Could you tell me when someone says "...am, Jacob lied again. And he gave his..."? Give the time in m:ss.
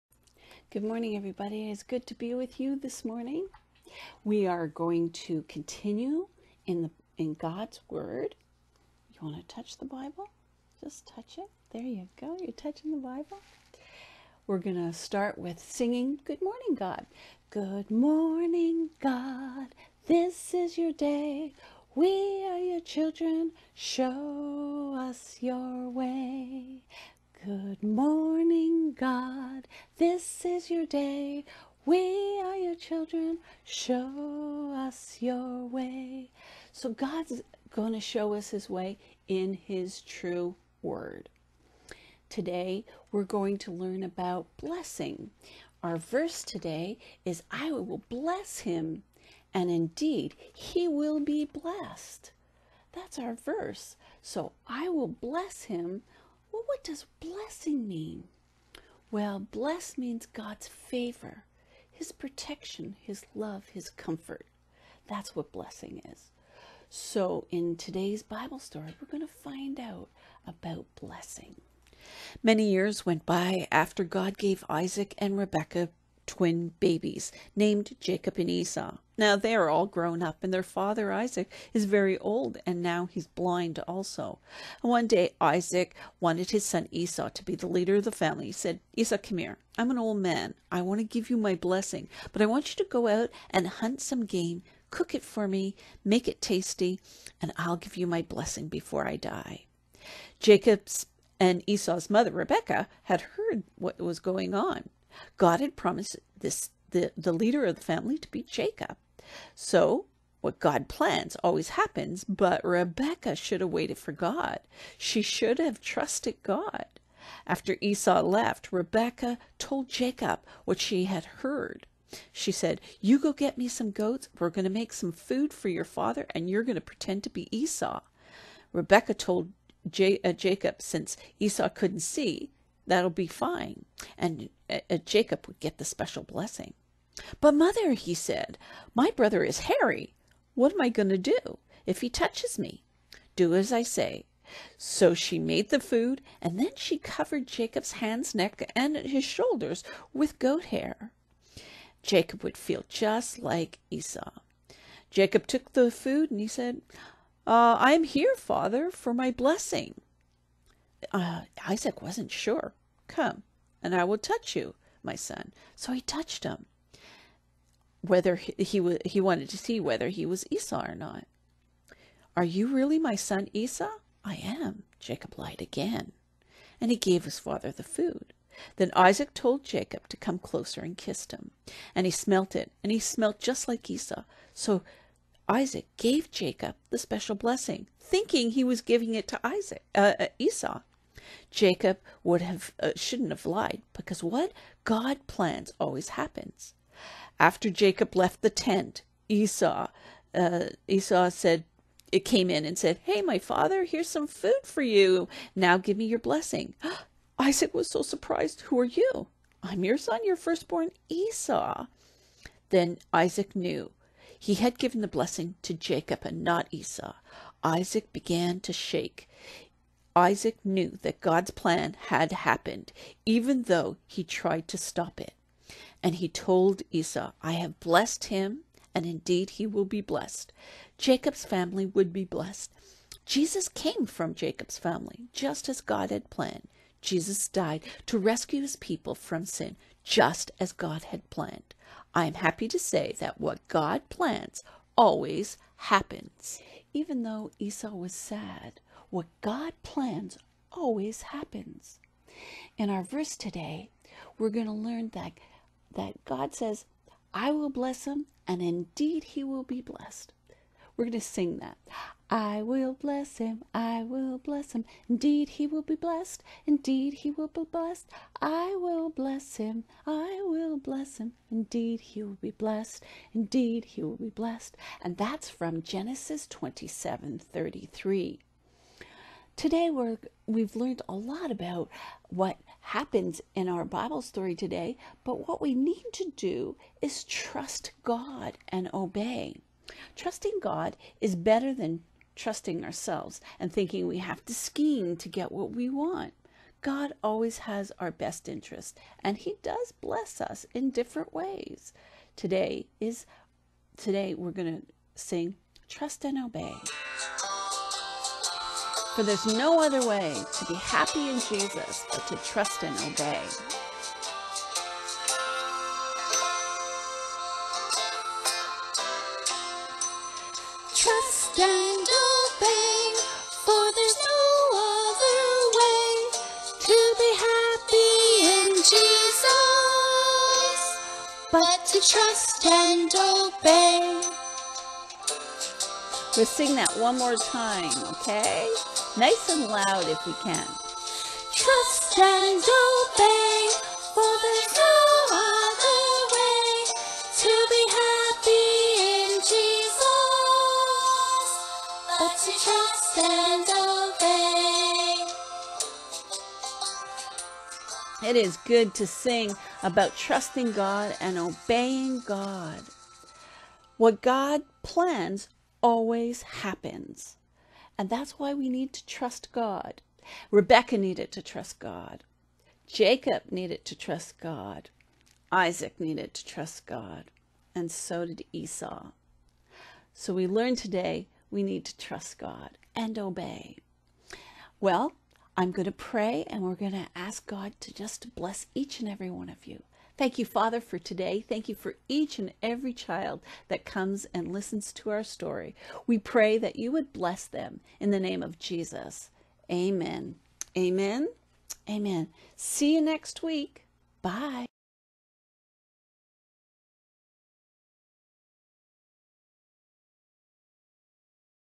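2:54.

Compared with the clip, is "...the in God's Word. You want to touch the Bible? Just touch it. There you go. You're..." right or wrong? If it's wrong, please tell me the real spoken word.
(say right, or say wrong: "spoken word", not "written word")
right.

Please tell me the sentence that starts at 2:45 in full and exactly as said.
So he touched him, whether he, he, he wanted to see whether he was Esau or not.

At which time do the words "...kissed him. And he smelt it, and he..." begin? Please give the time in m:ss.
3:00.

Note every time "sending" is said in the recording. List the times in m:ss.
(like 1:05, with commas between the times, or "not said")
not said.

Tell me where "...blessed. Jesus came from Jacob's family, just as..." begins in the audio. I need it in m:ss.
3:52.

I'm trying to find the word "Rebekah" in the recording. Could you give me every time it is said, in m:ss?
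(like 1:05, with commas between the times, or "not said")
1:15, 1:42, 1:52, 1:58, 2:08, 6:10.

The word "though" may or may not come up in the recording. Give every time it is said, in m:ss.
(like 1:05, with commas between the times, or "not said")
3:43, 4:07.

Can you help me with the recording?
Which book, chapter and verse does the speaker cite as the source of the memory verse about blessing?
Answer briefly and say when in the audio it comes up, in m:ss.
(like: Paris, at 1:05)
Genesis 27:33, at 4:35.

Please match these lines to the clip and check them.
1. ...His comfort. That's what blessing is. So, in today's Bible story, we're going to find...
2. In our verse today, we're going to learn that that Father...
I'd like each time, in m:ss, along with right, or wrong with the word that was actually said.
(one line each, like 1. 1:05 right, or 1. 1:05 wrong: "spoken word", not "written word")
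1. 1:03 right
2. 4:12 wrong: "God", not "Father".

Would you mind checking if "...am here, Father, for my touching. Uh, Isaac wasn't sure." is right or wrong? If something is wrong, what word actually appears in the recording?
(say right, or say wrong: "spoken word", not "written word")
wrong: "blessing", not "touching".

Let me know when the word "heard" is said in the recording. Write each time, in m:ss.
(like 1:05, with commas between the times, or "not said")
1:43, 2:01.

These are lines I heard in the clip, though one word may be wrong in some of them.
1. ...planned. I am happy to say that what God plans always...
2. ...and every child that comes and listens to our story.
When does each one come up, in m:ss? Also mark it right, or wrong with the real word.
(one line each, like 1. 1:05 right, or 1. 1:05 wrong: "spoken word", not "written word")
1. 4:01 right
2. 6:32 right.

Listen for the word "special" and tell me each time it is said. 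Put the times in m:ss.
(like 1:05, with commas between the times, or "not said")
2:15, 3:06.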